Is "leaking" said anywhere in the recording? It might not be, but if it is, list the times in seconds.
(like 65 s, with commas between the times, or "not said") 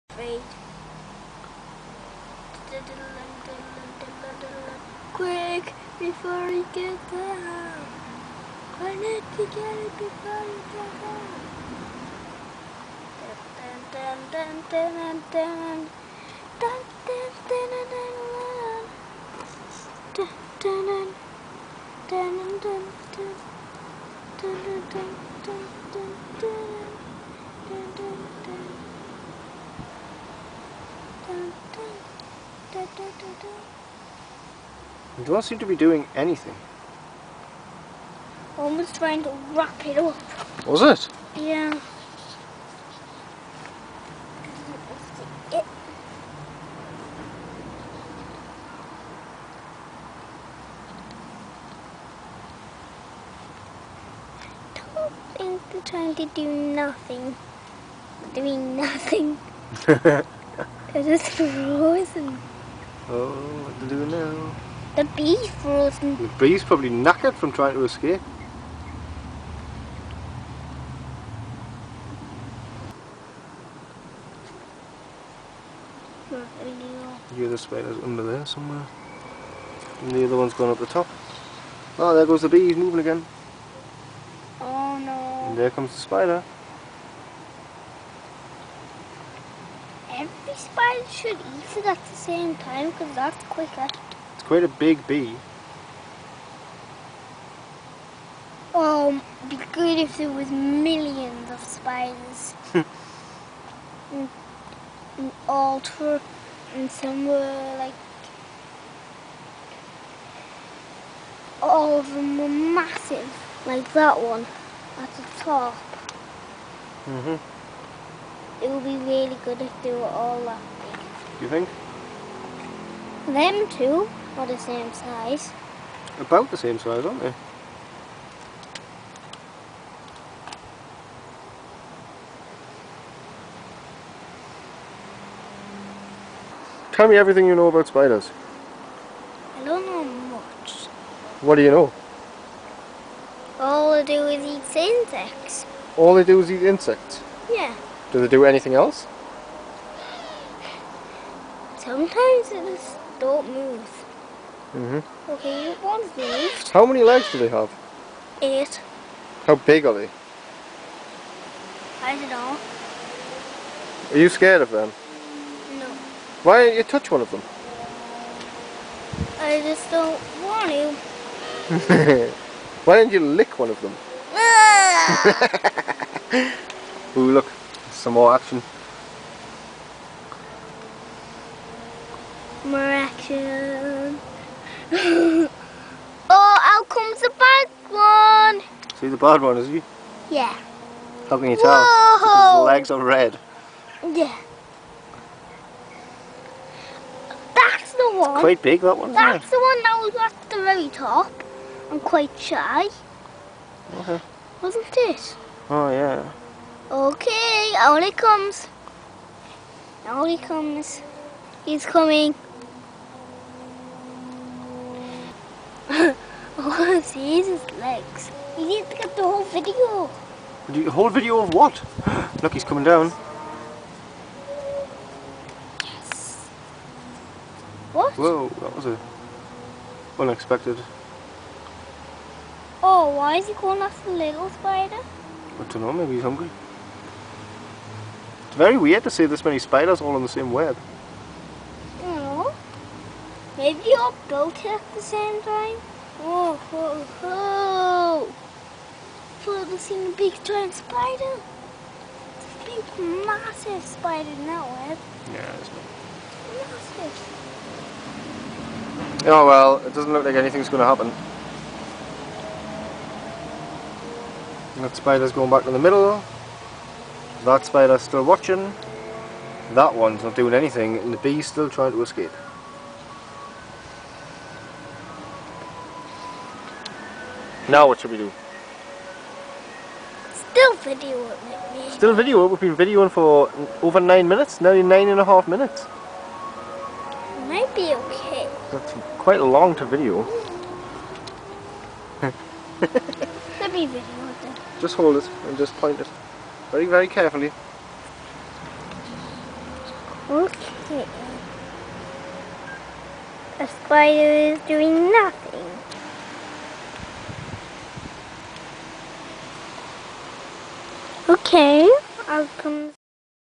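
not said.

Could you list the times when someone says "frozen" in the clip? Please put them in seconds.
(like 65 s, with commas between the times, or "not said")
61 s, 65 s.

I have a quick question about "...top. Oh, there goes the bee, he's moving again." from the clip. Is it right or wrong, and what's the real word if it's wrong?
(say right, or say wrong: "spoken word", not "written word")
right.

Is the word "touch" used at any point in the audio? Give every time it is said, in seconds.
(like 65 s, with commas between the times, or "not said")
166 s.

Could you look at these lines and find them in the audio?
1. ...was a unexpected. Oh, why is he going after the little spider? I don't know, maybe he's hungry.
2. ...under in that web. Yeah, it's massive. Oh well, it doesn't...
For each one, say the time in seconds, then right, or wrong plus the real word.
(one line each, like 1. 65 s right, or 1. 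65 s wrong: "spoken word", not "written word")
1. 228 s right
2. 253 s wrong: "spider", not "under".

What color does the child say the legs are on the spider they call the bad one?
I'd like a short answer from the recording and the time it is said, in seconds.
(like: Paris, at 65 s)
Red, at 192 s.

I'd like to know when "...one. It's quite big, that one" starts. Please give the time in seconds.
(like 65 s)
198 s.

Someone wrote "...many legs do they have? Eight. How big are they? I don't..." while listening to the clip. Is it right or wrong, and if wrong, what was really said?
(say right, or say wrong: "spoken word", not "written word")
right.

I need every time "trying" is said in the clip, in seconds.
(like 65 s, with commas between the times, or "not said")
38 s, 55 s, 67 s, 271 s.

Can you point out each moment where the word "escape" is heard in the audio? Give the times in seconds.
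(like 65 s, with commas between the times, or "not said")
67 s, 272 s.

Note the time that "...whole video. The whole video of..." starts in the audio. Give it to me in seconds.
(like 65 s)
219 s.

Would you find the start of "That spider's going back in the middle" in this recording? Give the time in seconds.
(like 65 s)
264 s.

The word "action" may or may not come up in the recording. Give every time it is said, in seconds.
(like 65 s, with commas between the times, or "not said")
178 s, 182 s.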